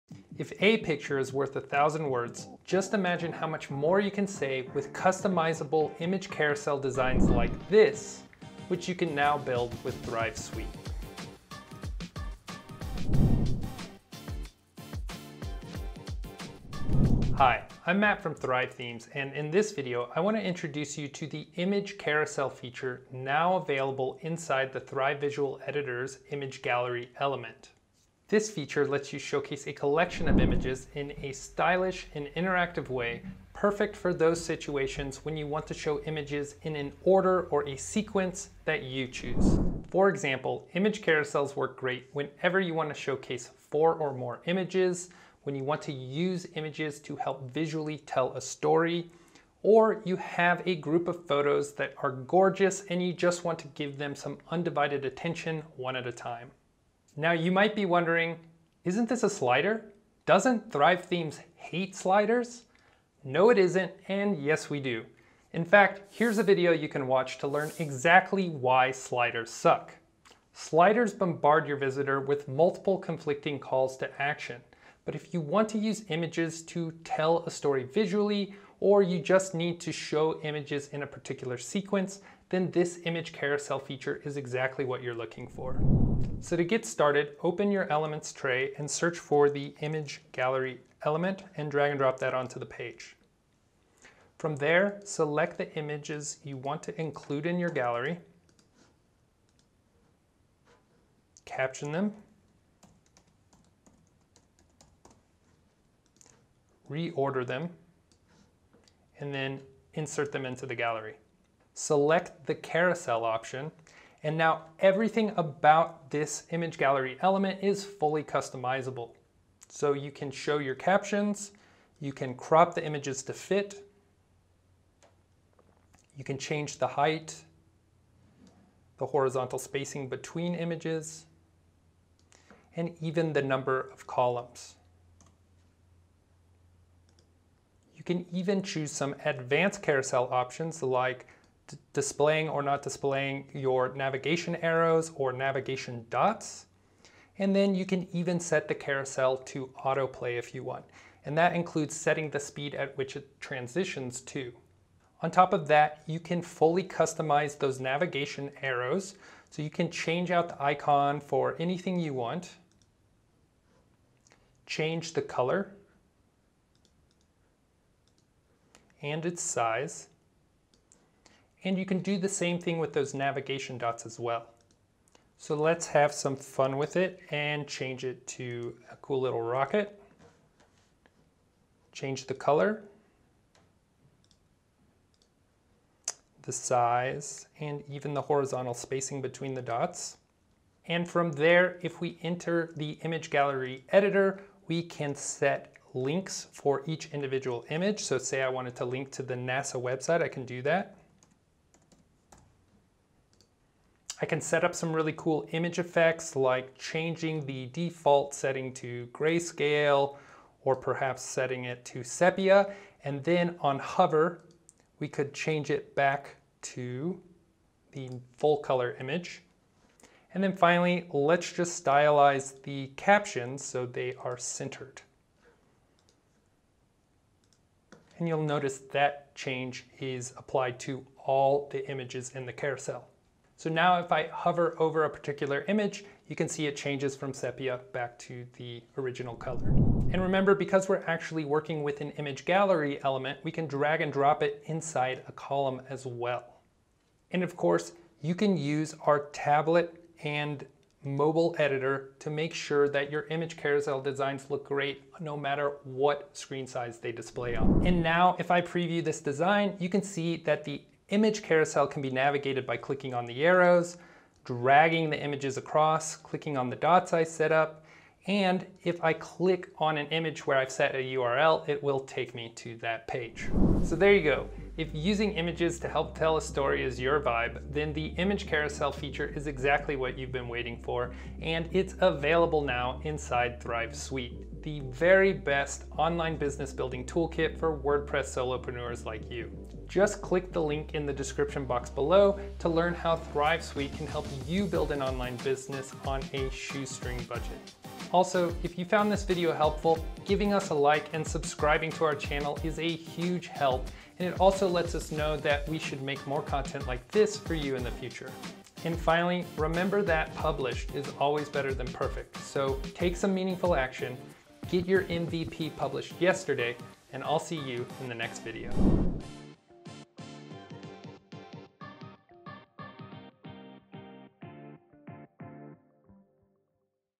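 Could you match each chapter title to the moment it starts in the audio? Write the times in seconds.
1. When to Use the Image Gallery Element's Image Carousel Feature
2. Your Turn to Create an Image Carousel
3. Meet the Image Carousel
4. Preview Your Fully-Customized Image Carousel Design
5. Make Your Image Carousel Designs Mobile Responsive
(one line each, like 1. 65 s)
1. 39 s
2. 274 s
3. 17 s
4. 258 s
5. 247 s.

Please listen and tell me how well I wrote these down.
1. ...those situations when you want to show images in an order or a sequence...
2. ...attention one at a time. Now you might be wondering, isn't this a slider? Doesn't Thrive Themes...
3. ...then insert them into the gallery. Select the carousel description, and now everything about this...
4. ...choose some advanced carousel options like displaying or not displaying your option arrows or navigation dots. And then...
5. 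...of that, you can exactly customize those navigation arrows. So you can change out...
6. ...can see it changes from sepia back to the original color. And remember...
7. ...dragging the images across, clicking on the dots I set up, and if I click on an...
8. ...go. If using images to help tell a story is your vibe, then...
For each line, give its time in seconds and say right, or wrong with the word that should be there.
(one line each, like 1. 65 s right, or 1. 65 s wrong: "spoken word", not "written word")
1. 34 s right
2. 55 s right
3. 109 s wrong: "option", not "description"
4. 138 s wrong: "navigation", not "option"
5. 155 s wrong: "fully", not "exactly"
6. 236 s right
7. 264 s right
8. 274 s right.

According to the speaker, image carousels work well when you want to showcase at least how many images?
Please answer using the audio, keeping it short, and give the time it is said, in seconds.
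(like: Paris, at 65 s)
4, at 43 s.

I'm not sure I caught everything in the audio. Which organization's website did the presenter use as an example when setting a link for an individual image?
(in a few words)
NASA.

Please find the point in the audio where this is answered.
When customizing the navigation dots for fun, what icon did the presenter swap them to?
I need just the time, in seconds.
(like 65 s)
179 s.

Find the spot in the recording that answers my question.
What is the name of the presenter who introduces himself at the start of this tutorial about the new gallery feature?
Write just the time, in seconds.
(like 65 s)
17 s.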